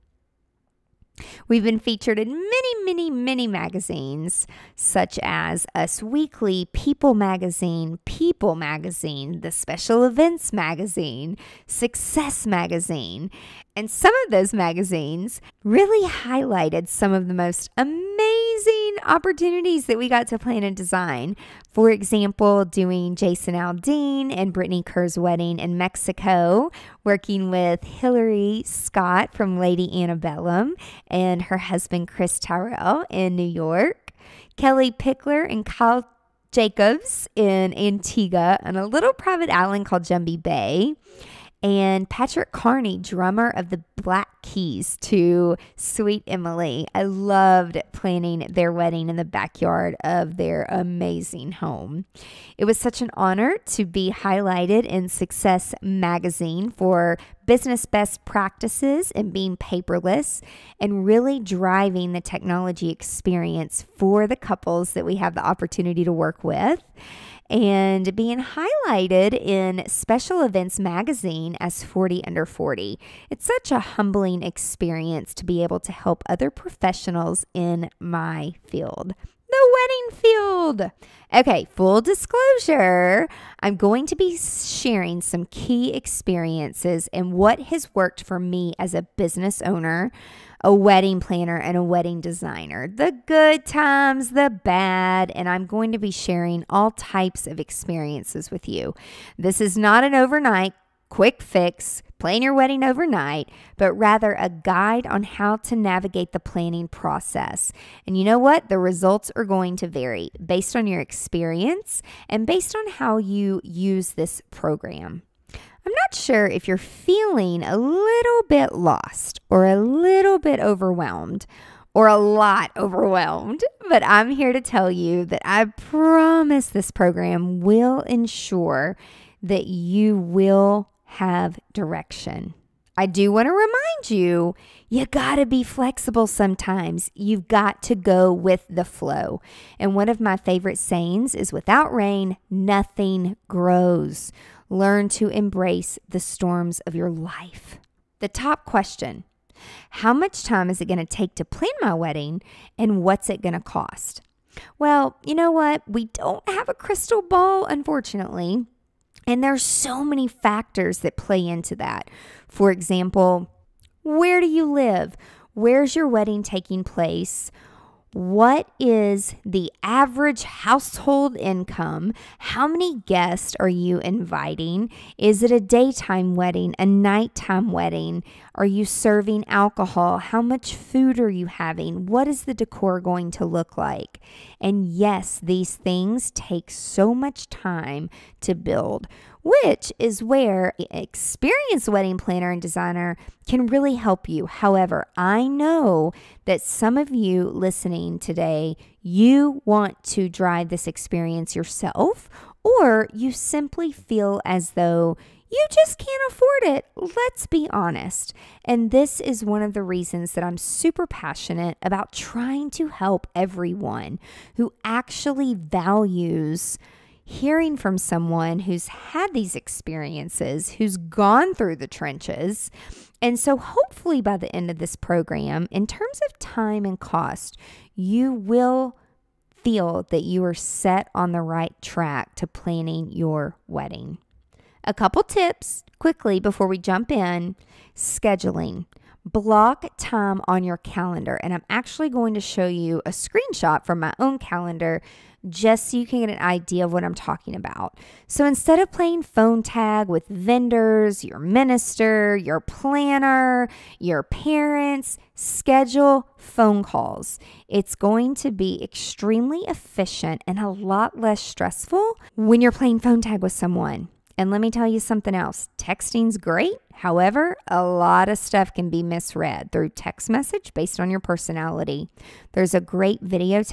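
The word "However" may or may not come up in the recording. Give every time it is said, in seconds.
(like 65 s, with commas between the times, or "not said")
194 s, 266 s.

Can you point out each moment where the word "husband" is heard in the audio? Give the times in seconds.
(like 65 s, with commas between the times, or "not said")
31 s.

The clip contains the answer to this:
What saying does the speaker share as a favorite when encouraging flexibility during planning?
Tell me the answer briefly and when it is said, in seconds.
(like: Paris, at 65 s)
Without rain, nothing grows, at 141 s.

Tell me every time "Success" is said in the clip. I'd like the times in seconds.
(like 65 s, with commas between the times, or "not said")
11 s, 55 s.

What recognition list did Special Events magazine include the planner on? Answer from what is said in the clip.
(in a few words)
40 under 40.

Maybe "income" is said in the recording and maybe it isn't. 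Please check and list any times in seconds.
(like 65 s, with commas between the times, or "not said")
171 s.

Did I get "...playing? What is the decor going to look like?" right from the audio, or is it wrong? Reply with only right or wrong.
wrong.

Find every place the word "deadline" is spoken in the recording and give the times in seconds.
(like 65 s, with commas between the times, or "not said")
not said.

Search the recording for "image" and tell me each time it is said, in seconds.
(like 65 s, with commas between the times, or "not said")
not said.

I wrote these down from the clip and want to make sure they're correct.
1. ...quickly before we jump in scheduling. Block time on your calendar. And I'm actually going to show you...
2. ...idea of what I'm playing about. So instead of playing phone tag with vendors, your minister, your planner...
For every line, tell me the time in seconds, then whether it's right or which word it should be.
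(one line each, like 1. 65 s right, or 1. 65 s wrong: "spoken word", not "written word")
1. 235 s right
2. 246 s wrong: "talking", not "playing".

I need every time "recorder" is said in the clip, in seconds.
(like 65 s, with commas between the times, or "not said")
not said.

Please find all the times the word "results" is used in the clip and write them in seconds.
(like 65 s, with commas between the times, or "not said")
108 s.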